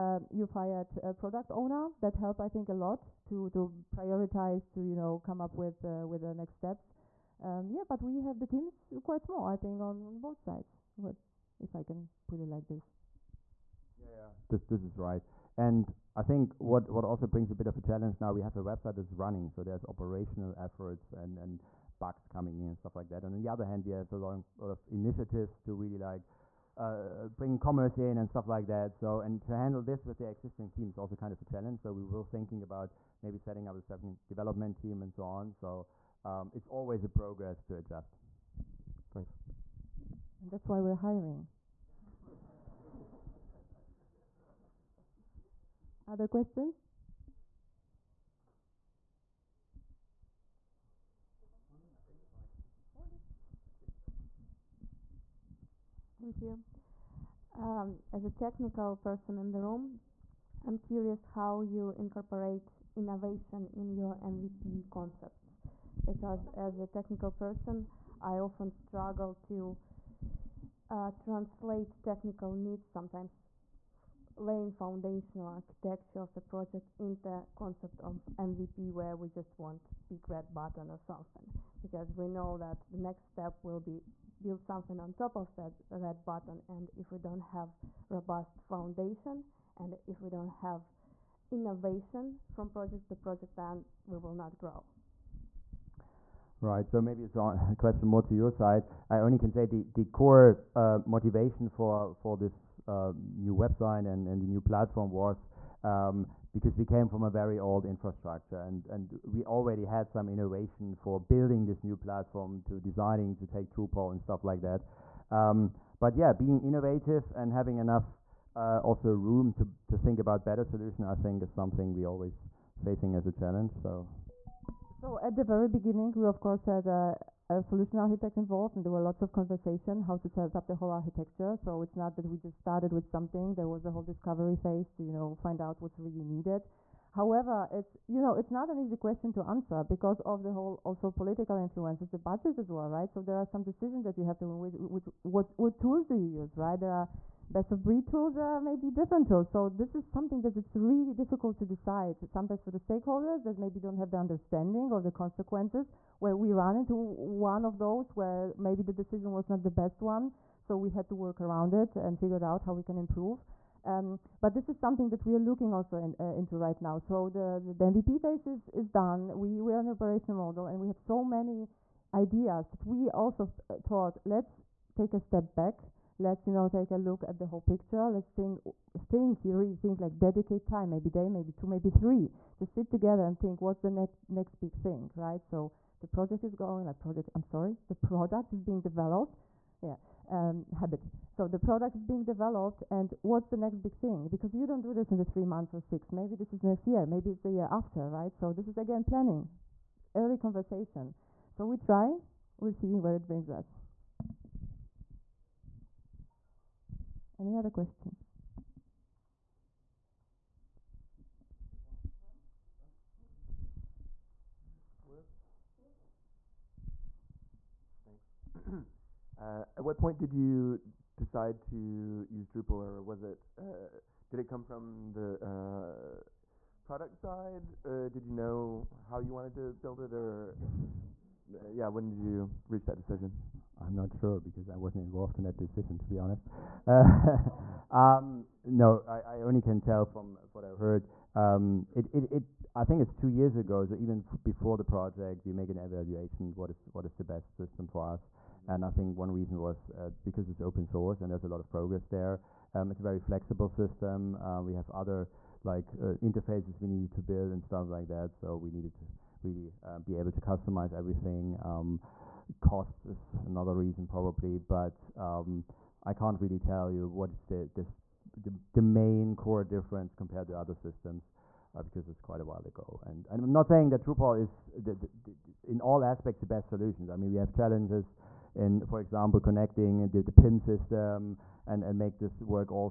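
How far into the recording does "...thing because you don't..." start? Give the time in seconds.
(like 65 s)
193 s.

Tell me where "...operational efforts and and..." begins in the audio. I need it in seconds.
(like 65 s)
19 s.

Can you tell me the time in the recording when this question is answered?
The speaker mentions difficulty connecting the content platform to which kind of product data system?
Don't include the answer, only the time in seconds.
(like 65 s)
280 s.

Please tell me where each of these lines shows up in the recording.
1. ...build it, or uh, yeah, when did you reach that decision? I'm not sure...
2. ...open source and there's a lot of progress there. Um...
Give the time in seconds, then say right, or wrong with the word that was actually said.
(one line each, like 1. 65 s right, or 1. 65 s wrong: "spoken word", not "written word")
1. 229 s right
2. 250 s right.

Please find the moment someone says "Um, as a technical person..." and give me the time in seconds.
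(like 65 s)
57 s.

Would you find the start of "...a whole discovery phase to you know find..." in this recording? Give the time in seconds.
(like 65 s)
133 s.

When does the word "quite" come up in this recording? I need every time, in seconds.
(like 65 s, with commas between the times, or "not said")
9 s, 272 s.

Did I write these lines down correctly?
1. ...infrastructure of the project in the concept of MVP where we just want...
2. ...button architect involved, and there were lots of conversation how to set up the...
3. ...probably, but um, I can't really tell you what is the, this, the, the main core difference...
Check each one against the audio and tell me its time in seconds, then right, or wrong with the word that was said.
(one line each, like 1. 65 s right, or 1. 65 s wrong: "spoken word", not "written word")
1. 75 s wrong: "architecture", not "infrastructure"
2. 127 s wrong: "solution", not "button"
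3. 264 s right.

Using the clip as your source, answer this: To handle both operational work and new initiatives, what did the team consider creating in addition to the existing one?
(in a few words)
second development team.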